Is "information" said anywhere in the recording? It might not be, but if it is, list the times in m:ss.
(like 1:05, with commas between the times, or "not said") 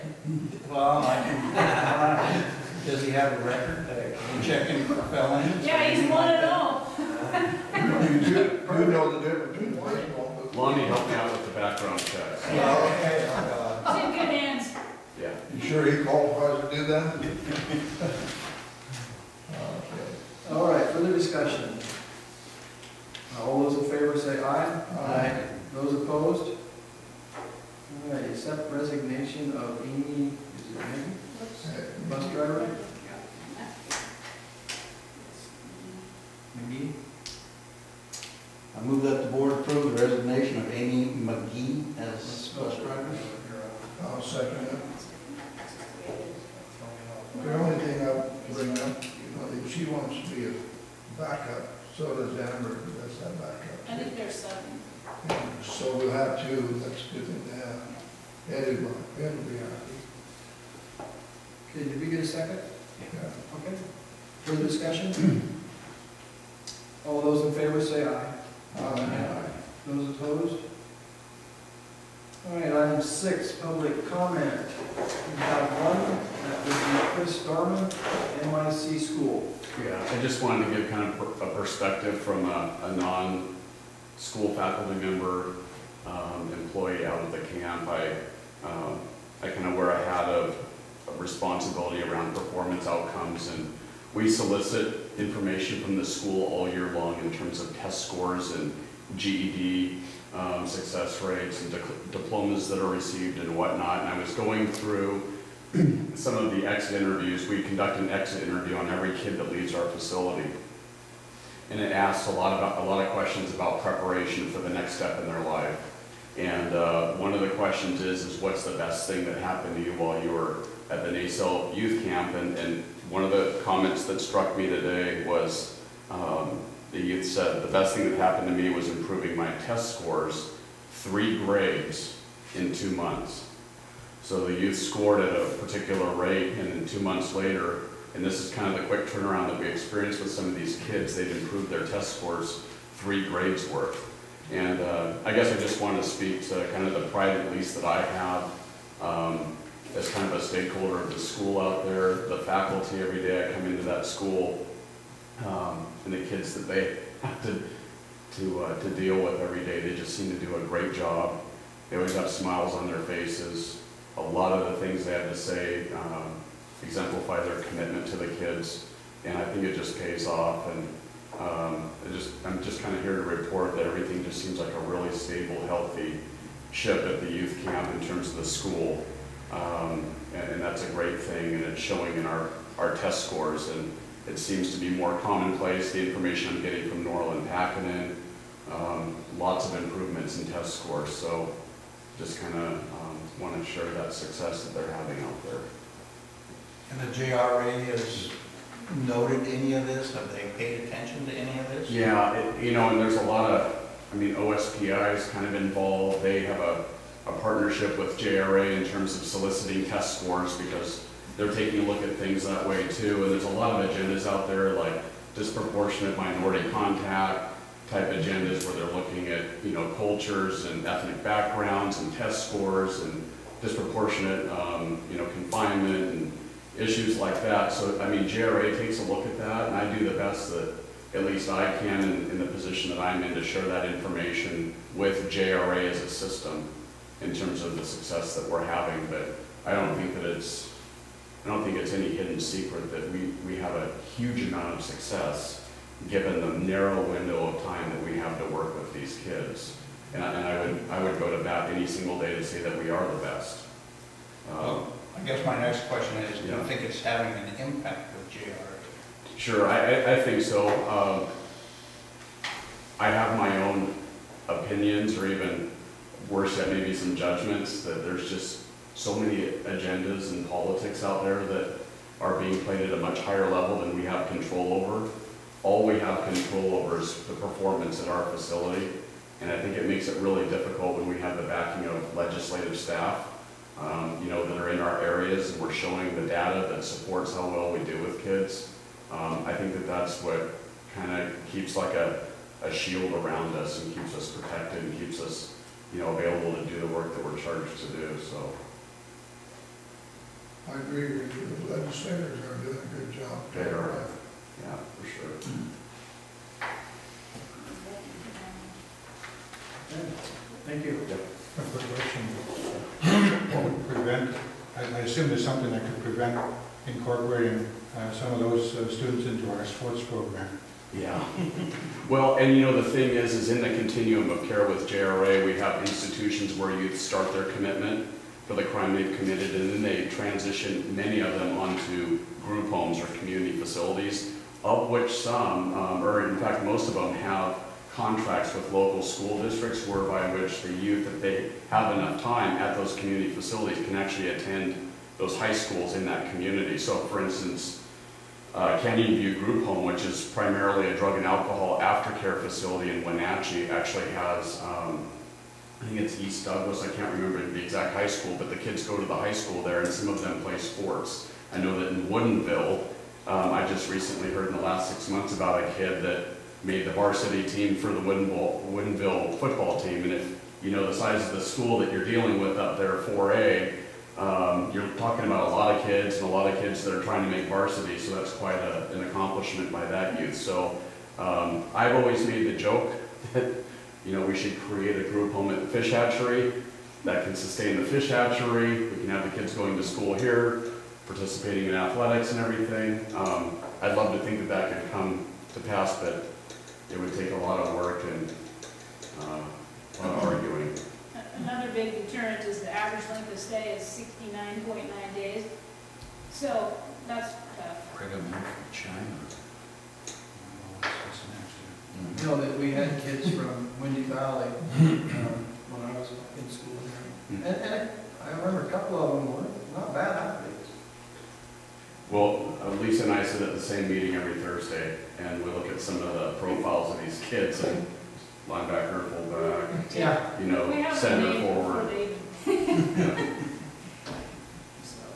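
1:35, 3:06, 3:53.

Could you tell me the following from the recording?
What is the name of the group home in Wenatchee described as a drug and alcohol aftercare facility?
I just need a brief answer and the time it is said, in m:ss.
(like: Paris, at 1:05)
Canyon View Group Home, at 5:48.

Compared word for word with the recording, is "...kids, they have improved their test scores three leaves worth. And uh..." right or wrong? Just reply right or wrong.
wrong.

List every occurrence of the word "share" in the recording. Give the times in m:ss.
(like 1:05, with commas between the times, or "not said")
3:13, 3:53.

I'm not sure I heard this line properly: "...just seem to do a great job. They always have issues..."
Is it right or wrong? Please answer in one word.
wrong.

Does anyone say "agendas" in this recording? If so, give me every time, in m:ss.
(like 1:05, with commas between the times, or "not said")
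3:33, 3:38, 4:29.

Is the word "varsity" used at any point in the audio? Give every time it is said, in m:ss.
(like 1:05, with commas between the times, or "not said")
6:06, 6:17.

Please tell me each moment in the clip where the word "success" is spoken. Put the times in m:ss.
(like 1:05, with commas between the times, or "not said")
1:40, 3:14, 3:57, 4:04.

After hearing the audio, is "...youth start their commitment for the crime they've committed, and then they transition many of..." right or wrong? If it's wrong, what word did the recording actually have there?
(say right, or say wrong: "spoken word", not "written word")
right.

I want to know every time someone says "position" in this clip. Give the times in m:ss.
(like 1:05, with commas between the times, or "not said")
3:52.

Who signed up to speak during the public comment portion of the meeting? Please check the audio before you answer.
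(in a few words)
Chris Darman.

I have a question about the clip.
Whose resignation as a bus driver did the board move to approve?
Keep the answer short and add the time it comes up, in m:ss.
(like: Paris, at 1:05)
Amy McGee, at 0:40.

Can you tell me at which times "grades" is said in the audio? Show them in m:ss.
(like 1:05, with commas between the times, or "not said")
2:11, 2:23.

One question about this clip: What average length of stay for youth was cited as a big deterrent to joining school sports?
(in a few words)
69.9 days.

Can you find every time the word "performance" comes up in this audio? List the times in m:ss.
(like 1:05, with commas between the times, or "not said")
1:32, 4:37.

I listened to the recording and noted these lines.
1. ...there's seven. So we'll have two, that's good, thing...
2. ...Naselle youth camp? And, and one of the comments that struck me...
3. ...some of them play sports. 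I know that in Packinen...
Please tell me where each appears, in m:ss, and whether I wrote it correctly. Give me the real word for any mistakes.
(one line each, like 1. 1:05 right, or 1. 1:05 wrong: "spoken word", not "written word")
1. 0:54 right
2. 2:01 right
3. 5:59 wrong: "Woodinville", not "Packinen".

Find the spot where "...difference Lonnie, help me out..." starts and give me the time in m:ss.
0:09.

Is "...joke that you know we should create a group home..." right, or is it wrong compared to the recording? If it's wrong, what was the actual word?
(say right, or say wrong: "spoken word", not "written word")
right.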